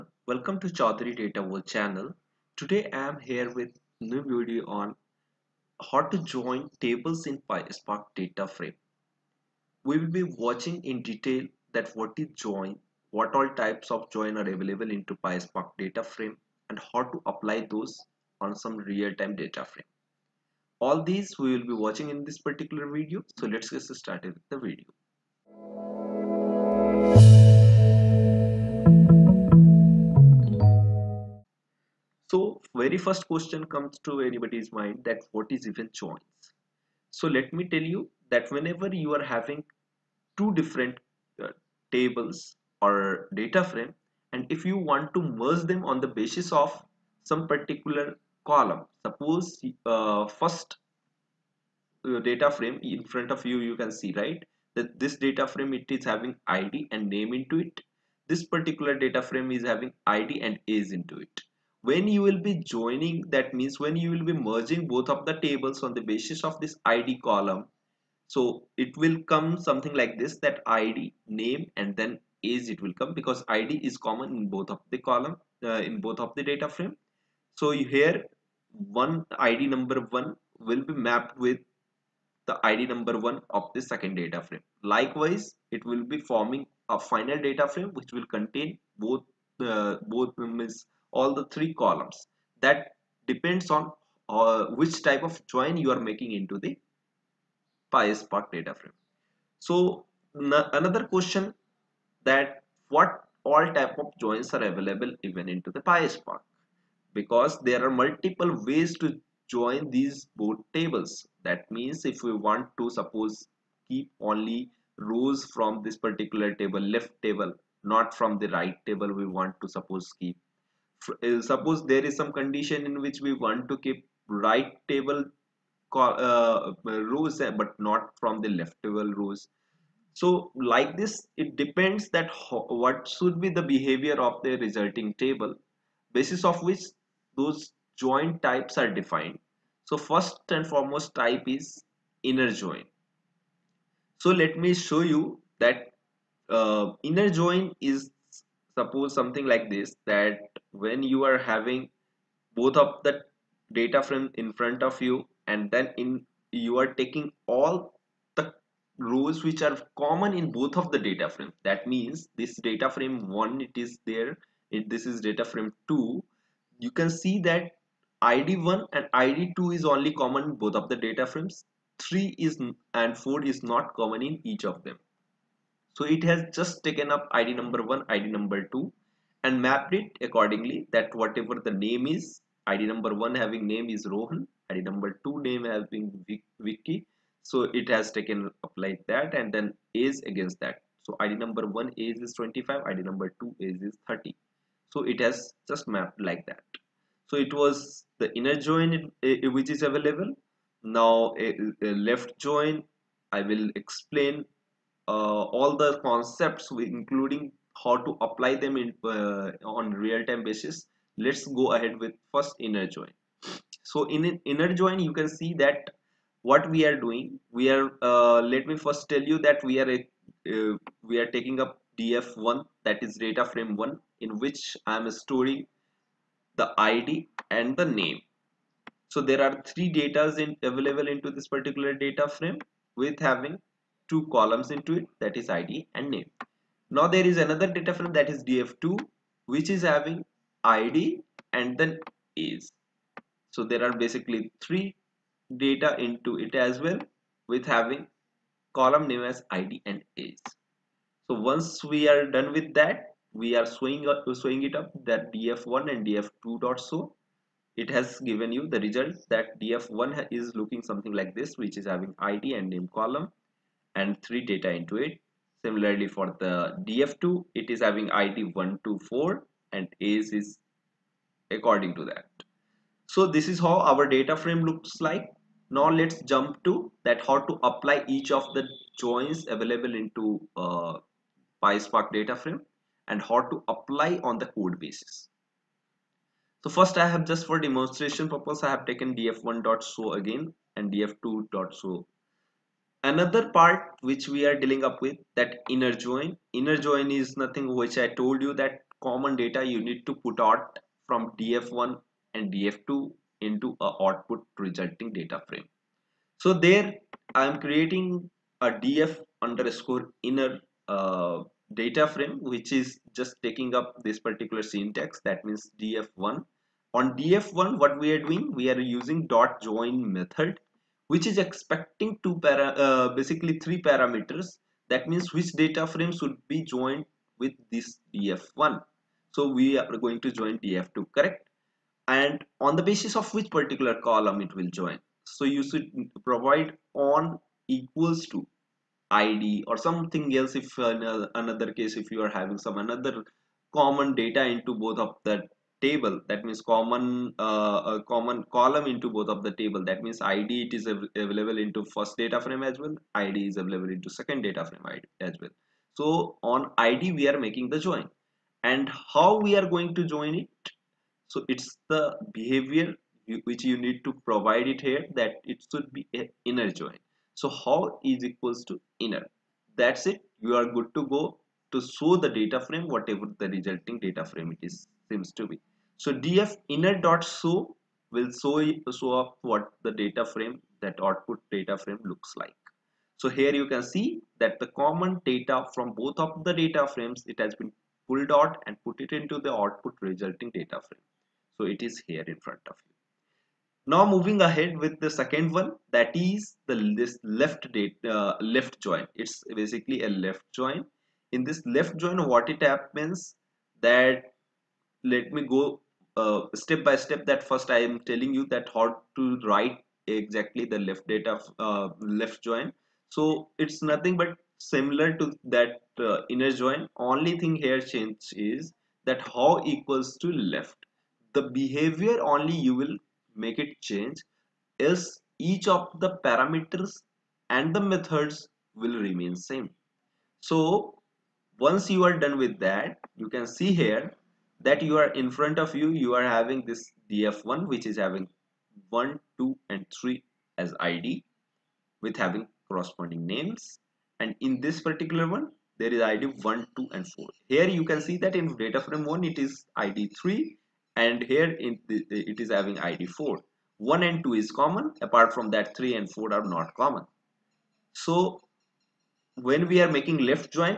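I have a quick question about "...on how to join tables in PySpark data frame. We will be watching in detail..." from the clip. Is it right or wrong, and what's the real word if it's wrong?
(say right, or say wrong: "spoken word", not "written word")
right.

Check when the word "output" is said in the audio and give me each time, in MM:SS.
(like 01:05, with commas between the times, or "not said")
05:04, 06:21, 06:29.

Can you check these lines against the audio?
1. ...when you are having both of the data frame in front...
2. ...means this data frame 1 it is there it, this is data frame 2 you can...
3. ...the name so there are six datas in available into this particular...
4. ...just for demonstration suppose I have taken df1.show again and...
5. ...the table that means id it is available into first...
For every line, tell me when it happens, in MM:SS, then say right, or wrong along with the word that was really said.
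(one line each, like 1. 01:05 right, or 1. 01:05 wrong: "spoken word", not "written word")
1. 02:30 right
2. 02:41 right
3. 03:47 wrong: "three", not "six"
4. 04:47 wrong: "purpose", not "suppose"
5. 05:49 right.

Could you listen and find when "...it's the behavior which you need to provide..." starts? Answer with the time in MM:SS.
06:01.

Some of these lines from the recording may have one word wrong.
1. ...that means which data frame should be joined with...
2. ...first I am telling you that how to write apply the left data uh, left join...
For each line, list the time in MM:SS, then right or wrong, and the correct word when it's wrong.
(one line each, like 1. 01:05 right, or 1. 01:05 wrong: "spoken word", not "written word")
1. 05:24 right
2. 06:47 wrong: "exactly", not "apply".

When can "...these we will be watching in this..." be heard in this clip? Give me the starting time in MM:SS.
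00:21.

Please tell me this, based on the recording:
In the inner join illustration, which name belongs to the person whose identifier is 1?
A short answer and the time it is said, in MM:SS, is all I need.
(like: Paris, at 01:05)
Rohan, at 03:04.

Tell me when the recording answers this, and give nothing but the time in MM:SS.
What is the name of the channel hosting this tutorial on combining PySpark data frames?
00:00.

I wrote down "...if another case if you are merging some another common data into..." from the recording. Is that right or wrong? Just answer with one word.
wrong.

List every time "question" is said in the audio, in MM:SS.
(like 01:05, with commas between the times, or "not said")
00:33, 01:41.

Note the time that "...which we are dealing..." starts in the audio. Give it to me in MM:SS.
04:54.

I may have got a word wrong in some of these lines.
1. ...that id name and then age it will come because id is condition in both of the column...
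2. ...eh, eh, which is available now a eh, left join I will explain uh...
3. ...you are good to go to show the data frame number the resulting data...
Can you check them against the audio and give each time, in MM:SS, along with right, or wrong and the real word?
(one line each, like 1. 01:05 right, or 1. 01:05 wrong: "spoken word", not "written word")
1. 01:10 wrong: "common", not "condition"
2. 03:18 right
3. 06:10 wrong: "whatever", not "number".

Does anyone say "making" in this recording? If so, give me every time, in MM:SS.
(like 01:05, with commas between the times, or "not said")
01:36, 05:57, 07:39.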